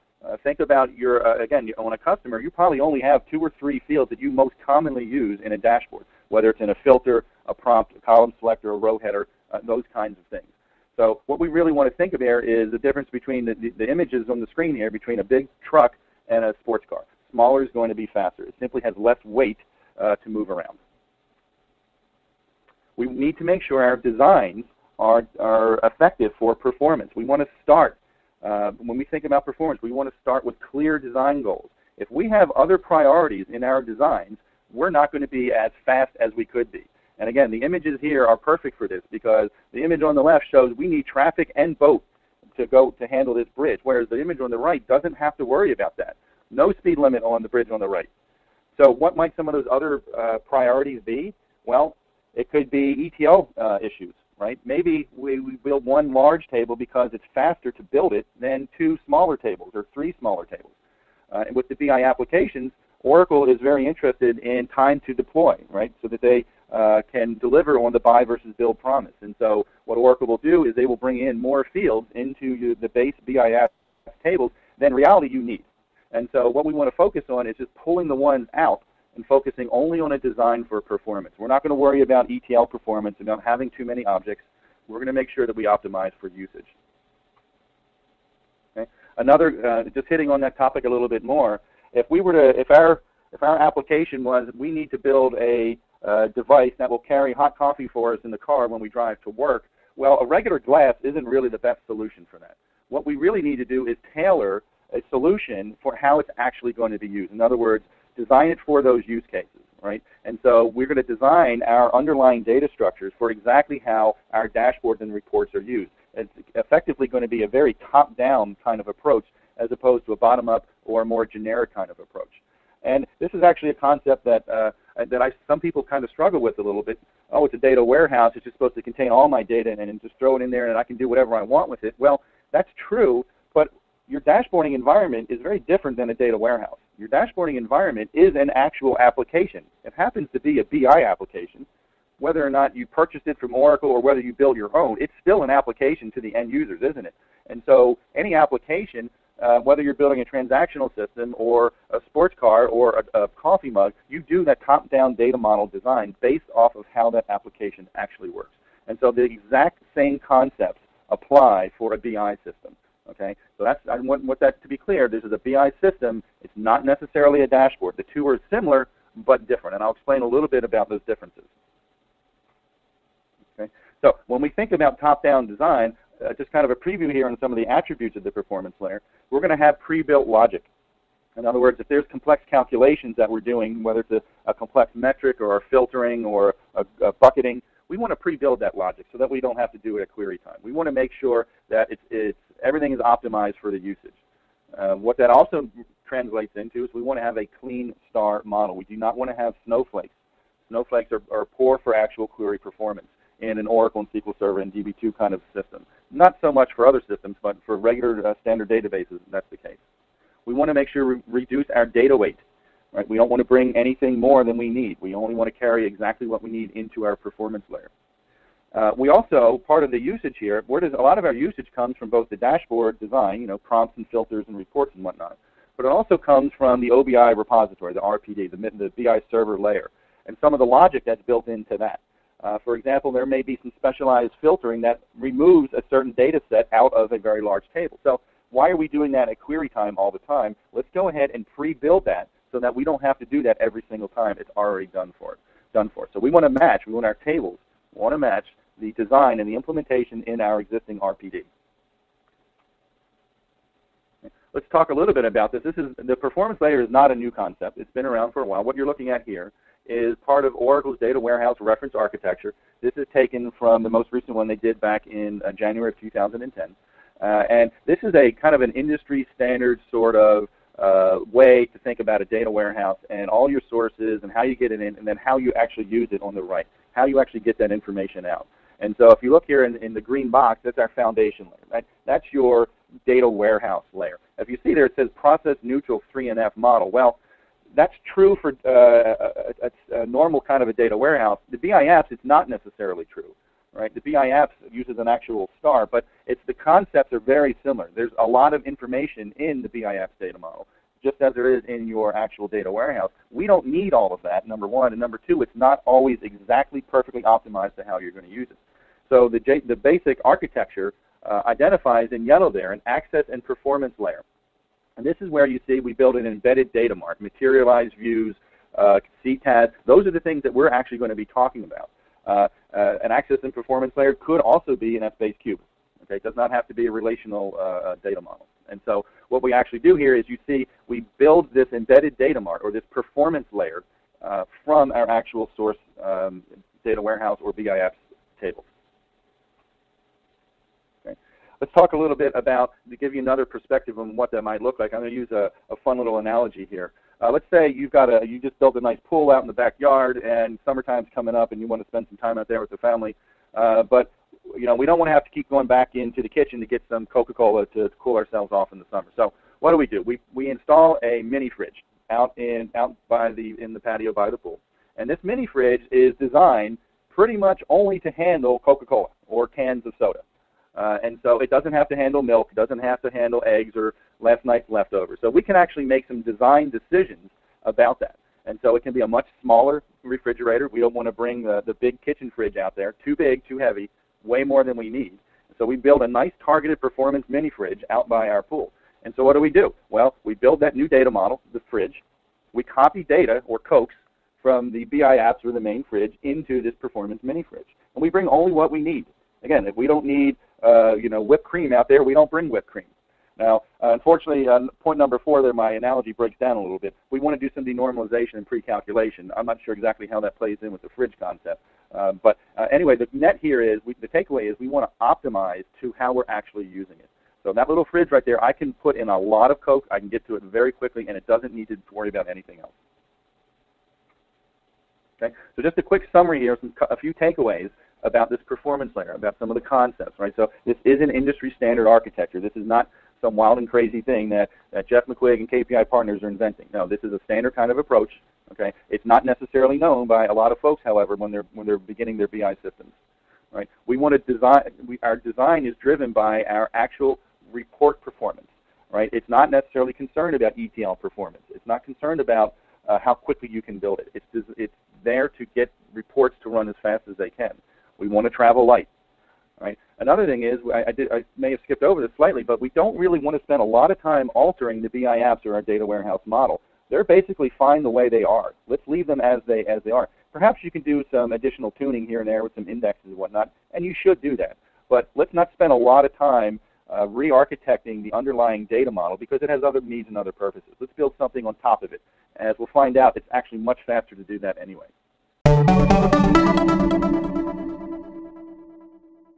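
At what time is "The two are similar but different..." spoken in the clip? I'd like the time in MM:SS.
02:47.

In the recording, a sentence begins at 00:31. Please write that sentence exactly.
If we have other priorities in our designs, we're not going to be as fast as we could be.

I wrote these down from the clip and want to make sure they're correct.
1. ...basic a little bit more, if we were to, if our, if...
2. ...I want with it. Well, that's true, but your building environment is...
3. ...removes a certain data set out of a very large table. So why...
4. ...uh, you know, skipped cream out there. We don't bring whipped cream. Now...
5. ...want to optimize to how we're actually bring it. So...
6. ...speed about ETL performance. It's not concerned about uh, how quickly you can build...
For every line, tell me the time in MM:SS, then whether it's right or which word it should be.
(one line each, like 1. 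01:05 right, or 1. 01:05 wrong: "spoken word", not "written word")
1. 01:30 wrong: "topic", not "basic"
2. 02:11 wrong: "dashboarding", not "building"
3. 03:55 right
4. 06:40 wrong: "whipped", not "skipped"
5. 06:54 wrong: "using", not "bring"
6. 07:29 wrong: "concerned", not "speed".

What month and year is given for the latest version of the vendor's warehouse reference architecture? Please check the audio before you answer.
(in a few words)
January 2010.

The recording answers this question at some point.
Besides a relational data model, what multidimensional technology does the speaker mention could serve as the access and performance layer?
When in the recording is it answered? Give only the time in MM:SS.
05:25.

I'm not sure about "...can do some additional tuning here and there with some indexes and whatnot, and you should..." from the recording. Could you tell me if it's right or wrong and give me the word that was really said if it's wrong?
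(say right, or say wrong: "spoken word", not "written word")
right.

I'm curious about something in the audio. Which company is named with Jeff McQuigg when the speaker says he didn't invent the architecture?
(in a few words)
KPI partners.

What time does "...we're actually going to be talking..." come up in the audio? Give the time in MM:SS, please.
05:20.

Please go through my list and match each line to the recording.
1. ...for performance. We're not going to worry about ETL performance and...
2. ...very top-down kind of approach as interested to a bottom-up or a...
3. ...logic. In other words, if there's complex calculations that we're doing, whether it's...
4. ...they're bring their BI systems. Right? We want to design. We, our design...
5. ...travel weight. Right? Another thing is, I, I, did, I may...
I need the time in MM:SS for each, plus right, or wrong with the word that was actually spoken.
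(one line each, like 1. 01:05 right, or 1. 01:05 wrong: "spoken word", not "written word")
1. 01:20 right
2. 01:57 wrong: "opposed", not "interested"
3. 03:00 right
4. 07:21 wrong: "beginning", not "bring"
5. 07:38 wrong: "light", not "weight".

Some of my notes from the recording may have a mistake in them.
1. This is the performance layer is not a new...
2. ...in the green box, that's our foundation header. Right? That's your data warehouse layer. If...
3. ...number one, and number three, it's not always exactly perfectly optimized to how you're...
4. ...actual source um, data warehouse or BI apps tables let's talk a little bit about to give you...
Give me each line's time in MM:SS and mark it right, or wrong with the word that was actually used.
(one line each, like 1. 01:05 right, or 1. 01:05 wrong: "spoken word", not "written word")
1. 04:15 right
2. 04:39 wrong: "layer", not "header"
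3. 05:04 wrong: "two", not "three"
4. 05:35 right.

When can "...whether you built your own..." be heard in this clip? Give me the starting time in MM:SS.
02:24.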